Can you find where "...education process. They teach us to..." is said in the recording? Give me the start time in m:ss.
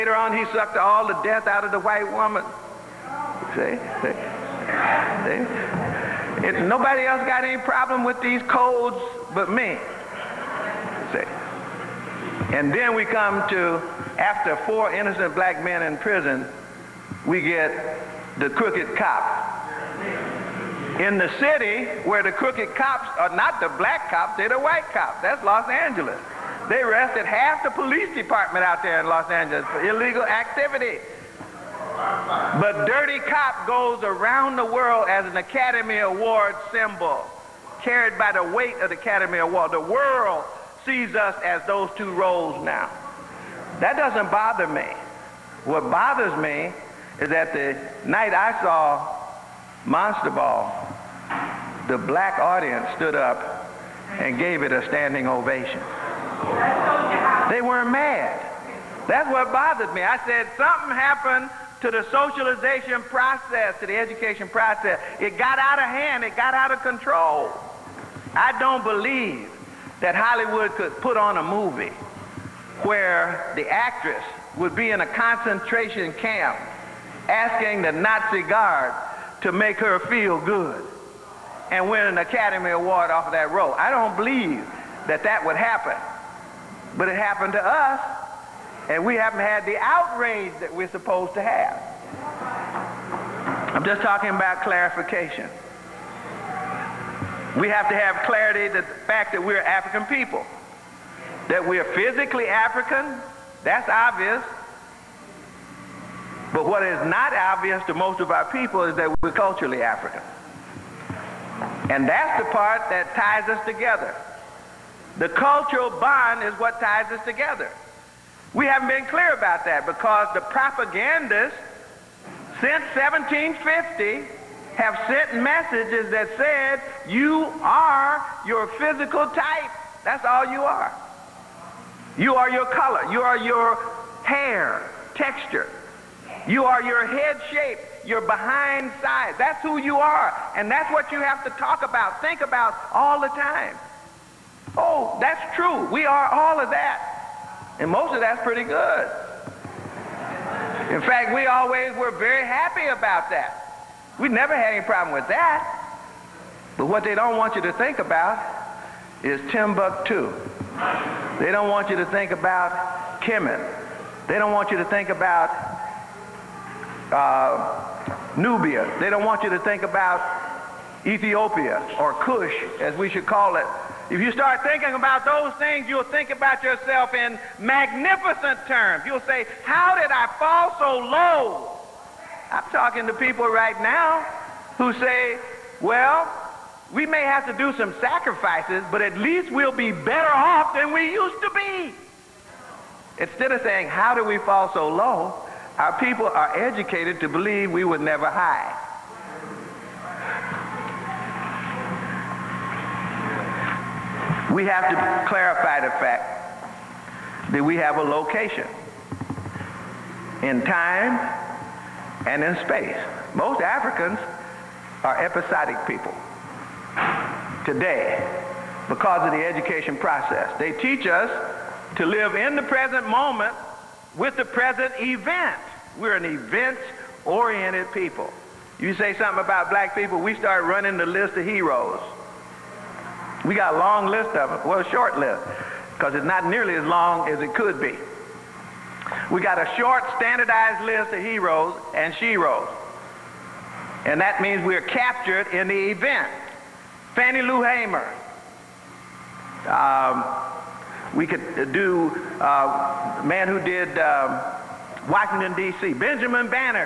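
3:39.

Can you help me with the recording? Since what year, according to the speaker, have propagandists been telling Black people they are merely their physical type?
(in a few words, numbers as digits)
1750.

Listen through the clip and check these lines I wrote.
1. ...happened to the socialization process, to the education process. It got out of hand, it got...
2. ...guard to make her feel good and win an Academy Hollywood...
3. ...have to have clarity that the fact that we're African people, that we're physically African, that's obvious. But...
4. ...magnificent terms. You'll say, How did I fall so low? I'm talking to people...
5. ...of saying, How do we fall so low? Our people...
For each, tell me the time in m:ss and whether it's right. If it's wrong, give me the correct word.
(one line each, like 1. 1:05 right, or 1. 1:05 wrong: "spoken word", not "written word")
1. 1:00 right
2. 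1:18 wrong: "Award", not "Hollywood"
3. 1:37 right
4. 2:57 right
5. 3:13 right.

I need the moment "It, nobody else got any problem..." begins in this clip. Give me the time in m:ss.
0:06.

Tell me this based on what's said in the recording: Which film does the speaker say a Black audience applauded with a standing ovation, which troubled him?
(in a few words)
Monster's Ball.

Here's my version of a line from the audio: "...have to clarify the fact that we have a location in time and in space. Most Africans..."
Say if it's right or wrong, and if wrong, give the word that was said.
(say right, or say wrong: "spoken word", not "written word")
right.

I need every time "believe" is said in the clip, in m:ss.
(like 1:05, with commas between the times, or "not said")
1:08, 1:24, 3:17.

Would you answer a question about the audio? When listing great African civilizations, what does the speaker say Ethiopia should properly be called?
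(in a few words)
Cush.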